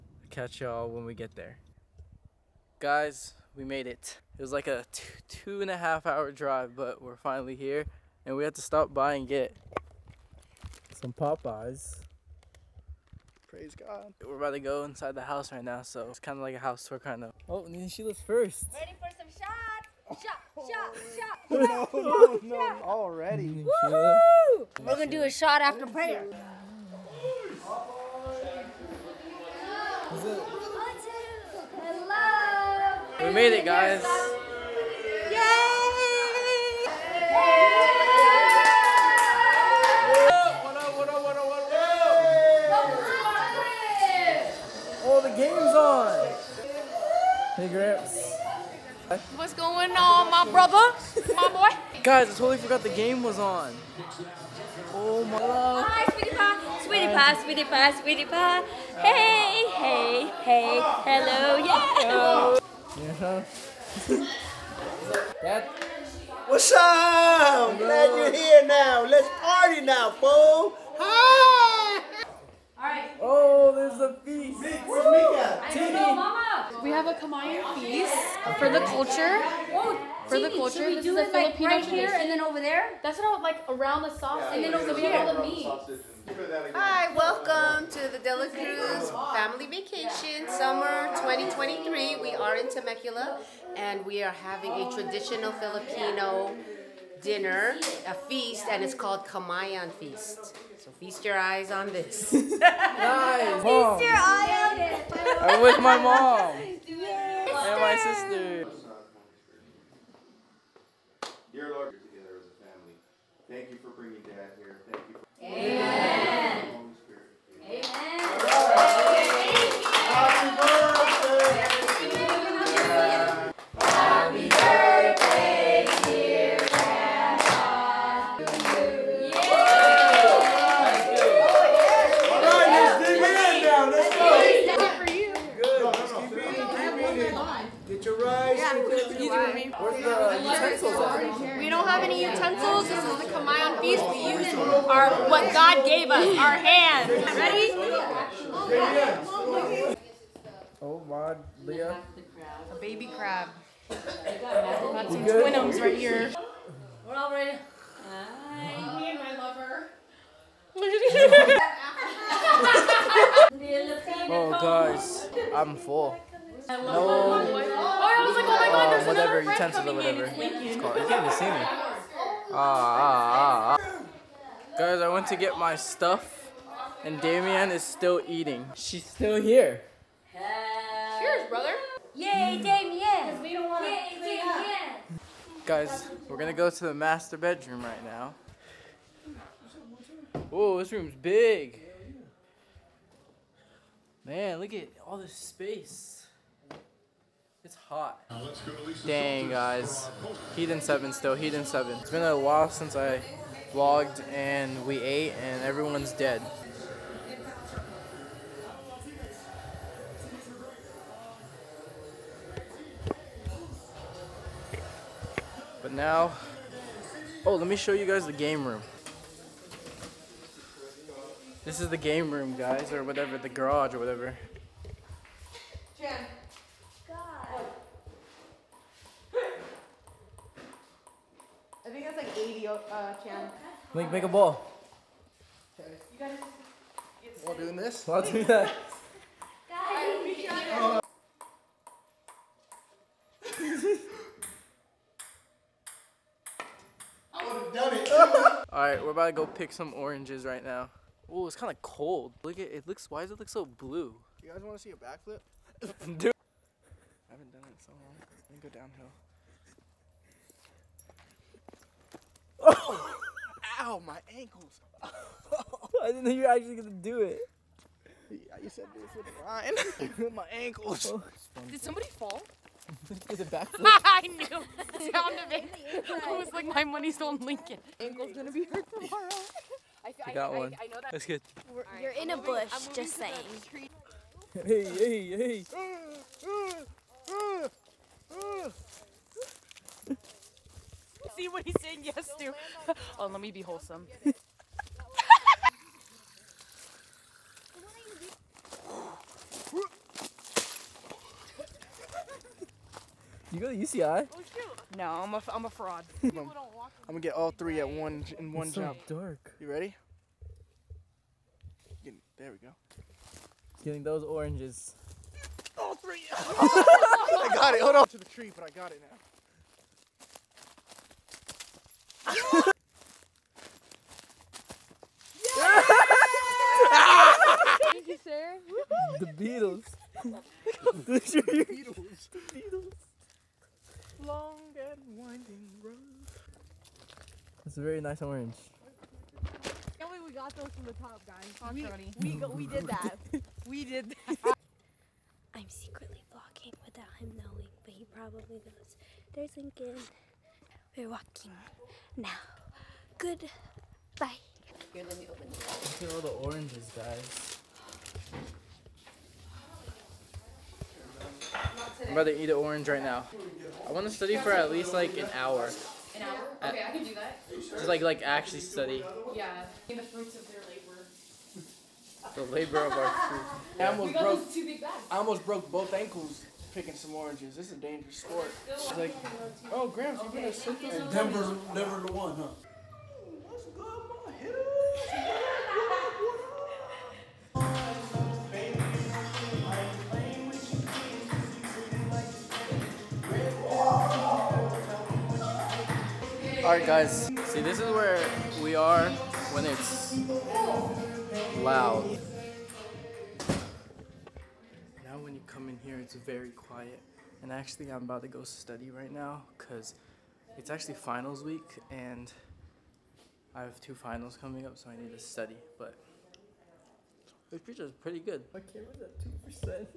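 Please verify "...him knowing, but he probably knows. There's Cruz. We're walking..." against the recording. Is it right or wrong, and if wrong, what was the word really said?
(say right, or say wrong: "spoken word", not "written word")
wrong: "Lincoln", not "Cruz".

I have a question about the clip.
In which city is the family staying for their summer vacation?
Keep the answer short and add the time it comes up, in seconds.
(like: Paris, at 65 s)
Temecula, at 92 s.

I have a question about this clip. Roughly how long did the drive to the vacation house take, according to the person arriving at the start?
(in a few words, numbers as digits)
2 and a half hours.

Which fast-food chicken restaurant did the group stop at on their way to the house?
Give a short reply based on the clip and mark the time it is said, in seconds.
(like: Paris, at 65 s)
Popeyes, at 11 s.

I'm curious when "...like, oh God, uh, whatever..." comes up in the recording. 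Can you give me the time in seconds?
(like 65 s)
168 s.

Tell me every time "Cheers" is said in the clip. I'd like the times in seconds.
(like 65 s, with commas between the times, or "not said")
181 s.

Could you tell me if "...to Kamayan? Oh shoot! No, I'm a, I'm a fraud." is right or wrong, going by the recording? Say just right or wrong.
wrong.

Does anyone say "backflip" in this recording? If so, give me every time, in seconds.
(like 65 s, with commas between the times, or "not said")
254 s, 273 s.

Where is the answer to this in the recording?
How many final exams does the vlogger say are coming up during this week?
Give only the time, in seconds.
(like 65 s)
413 s.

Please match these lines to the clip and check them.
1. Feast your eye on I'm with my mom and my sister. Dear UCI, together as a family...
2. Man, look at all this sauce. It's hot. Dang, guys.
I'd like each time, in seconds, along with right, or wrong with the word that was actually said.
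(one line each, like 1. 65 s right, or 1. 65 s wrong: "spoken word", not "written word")
1. 102 s wrong: "Lord", not "UCI"
2. 194 s wrong: "space", not "sauce".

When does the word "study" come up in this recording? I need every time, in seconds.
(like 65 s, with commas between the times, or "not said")
364 s, 368 s, 408 s, 415 s.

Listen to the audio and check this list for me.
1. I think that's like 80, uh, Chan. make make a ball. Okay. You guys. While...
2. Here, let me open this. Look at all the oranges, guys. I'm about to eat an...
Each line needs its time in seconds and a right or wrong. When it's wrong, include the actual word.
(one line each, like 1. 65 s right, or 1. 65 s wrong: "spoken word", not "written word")
1. 231 s right
2. 354 s right.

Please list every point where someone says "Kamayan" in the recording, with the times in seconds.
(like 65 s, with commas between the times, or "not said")
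77 s, 99 s.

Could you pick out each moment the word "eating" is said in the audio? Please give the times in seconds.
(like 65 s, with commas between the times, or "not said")
178 s.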